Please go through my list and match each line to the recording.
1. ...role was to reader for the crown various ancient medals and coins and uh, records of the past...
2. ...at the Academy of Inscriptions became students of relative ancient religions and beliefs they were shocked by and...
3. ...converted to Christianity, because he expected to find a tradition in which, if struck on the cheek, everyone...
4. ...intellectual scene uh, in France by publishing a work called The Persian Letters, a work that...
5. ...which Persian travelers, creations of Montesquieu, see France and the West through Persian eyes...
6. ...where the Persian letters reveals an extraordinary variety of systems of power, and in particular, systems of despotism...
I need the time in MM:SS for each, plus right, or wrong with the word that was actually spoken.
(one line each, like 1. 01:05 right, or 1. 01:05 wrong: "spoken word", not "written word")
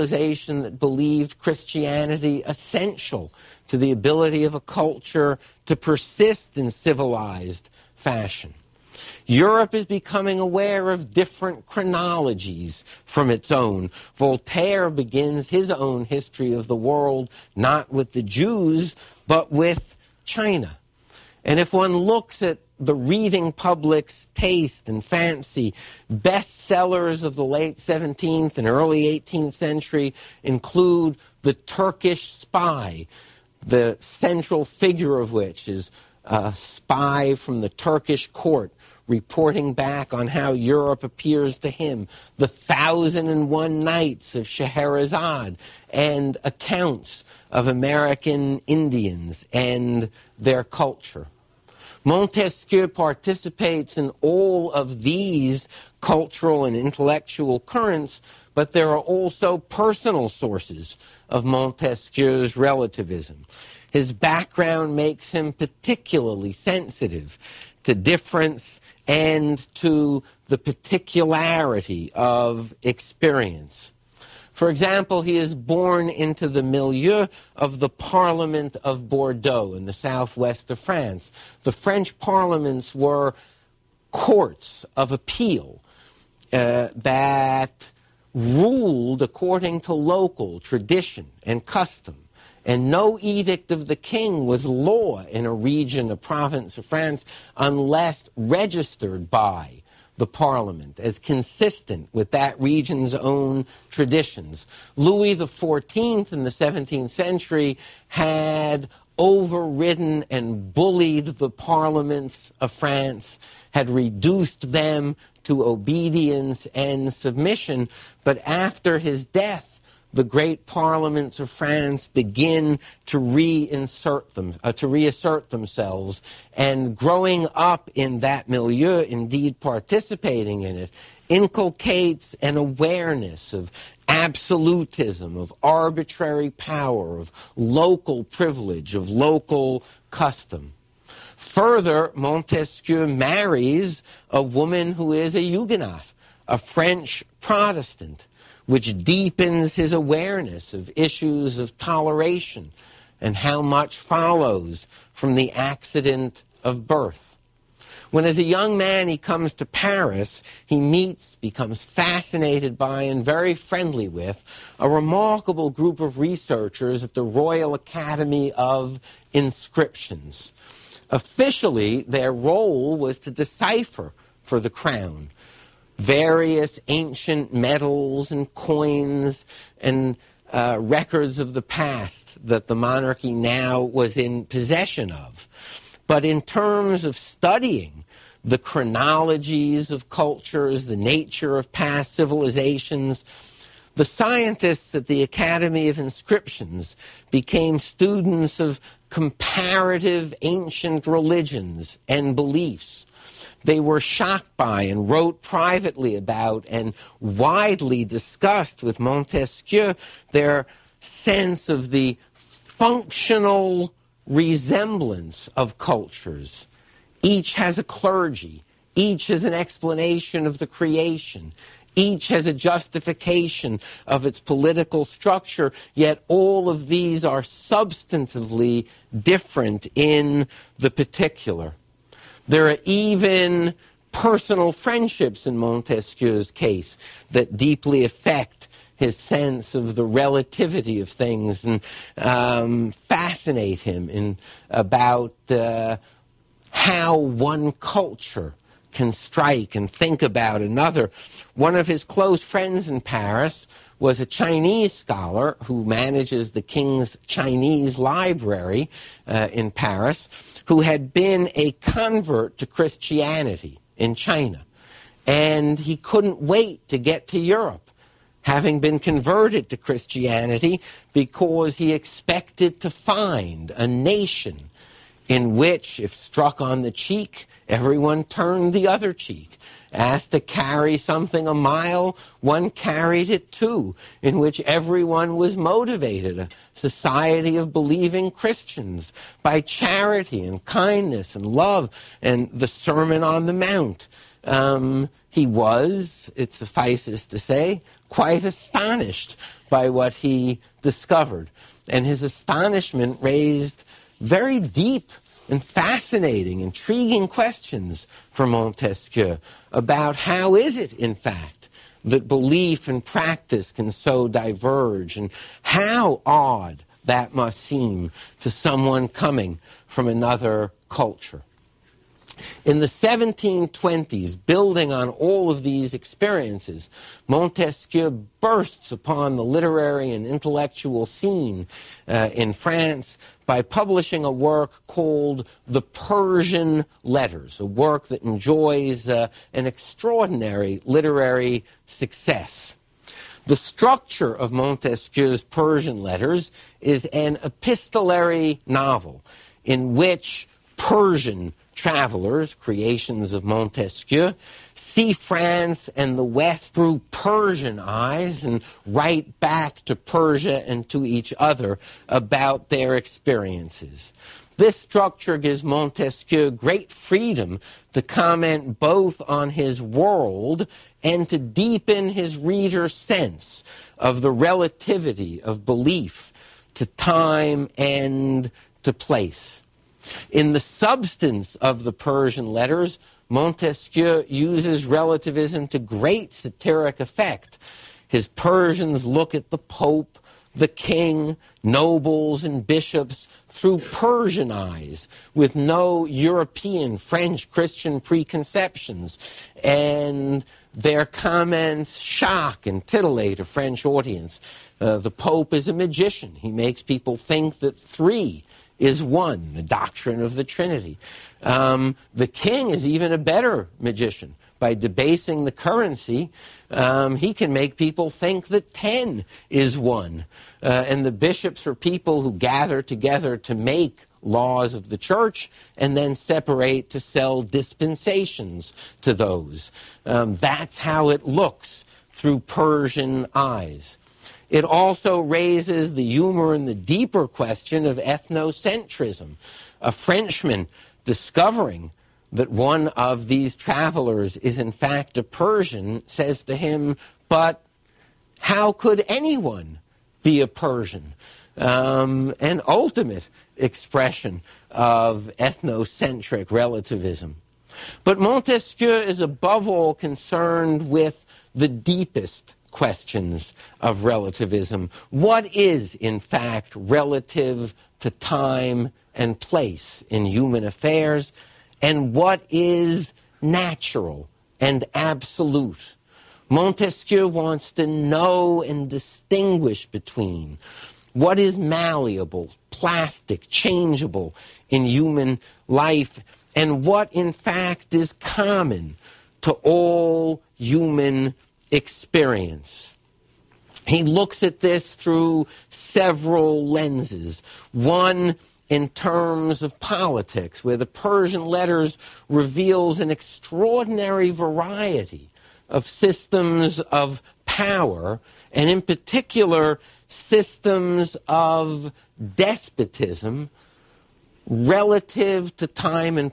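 1. 02:52 wrong: "decipher", not "reader"
2. 03:14 wrong: "comparative", not "relative"
3. 04:28 wrong: "nation", not "tradition"
4. 05:30 right
5. 05:49 right
6. 08:20 right.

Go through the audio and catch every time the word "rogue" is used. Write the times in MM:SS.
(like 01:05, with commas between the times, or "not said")
not said.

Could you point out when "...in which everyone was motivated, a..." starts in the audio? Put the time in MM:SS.
04:44.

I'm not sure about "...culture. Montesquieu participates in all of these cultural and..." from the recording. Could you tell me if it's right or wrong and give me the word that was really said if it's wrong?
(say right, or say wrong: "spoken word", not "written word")
right.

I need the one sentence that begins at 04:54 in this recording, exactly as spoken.
Um, he was, it suffices to say, quite astonished by what he discovered.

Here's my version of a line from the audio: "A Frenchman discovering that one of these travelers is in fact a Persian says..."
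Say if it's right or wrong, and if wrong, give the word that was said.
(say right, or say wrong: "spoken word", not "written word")
right.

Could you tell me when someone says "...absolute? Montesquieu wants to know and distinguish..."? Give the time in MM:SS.
07:54.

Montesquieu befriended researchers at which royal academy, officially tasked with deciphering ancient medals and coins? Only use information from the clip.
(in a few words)
Royal Academy of Inscriptions.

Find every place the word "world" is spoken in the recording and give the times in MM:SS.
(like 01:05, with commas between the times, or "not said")
00:16, 06:09.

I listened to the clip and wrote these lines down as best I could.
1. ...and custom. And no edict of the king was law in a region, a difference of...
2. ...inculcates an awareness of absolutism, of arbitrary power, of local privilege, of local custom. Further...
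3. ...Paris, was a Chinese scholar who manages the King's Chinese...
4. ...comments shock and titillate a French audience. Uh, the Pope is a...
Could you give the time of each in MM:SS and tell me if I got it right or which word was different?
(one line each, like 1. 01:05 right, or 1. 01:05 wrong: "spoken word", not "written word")
1. 01:31 wrong: "province", not "difference"
2. 02:11 right
3. 04:13 right
4. 06:41 right.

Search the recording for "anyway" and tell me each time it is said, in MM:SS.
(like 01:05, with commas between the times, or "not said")
not said.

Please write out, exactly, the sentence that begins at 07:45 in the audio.
What is, in fact, relative to time and place in human affairs?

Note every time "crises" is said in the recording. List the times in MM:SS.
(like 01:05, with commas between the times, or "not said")
not said.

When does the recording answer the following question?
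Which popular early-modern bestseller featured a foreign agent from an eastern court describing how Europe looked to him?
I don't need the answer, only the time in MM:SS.
00:31.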